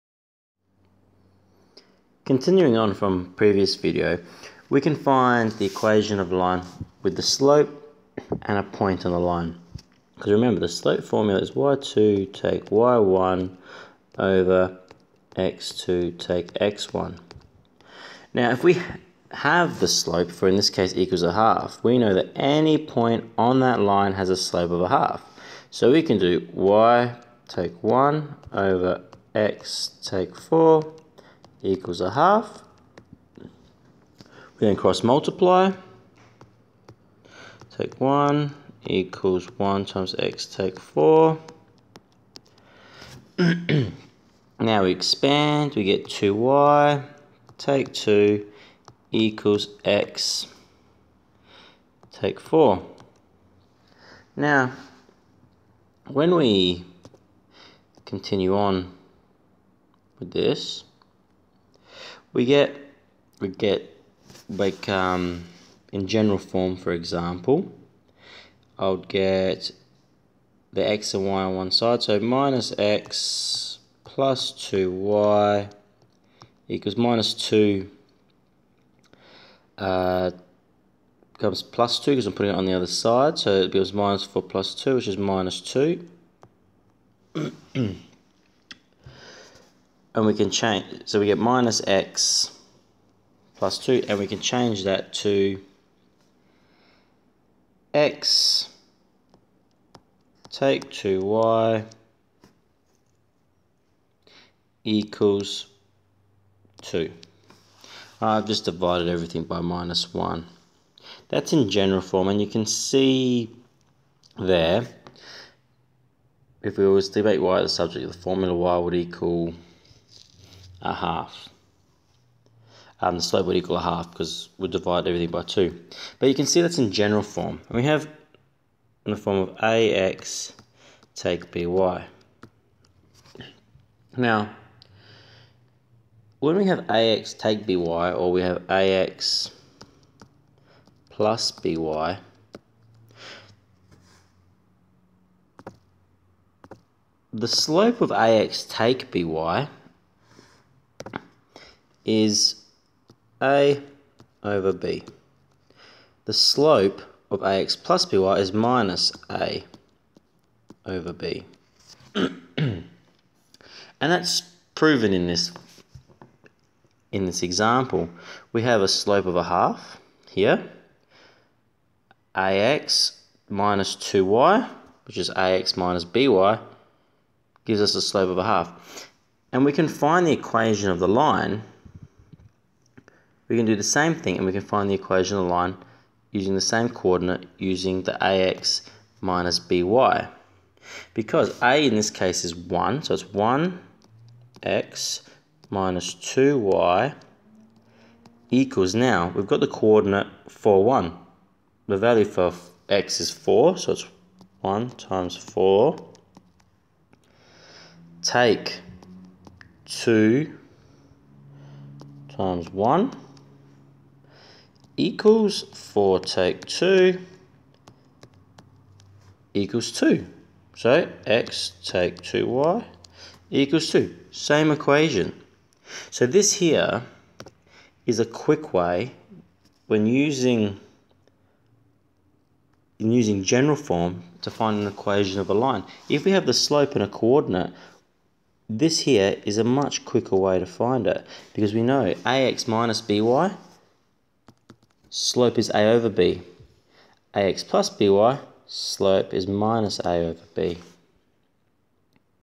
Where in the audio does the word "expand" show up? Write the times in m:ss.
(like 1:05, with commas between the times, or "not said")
0:44.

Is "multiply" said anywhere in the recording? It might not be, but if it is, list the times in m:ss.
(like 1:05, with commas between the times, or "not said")
0:35.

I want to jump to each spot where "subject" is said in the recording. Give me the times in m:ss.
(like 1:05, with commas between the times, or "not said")
1:57.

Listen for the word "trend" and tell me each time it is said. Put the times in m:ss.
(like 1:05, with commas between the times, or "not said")
not said.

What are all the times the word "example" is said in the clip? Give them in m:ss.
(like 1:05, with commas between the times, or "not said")
1:06, 2:47.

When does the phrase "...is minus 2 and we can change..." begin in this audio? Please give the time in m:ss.
1:25.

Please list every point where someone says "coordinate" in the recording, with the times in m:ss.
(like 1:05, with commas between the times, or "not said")
3:06, 3:19, 3:57.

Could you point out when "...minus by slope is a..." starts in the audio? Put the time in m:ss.
4:02.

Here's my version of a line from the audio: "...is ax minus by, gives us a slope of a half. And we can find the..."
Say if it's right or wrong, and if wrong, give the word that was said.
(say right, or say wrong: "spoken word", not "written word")
right.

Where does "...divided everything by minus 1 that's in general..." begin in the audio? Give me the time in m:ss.
1:48.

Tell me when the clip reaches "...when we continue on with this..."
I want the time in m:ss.
0:56.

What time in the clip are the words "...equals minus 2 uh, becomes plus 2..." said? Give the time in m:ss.
1:16.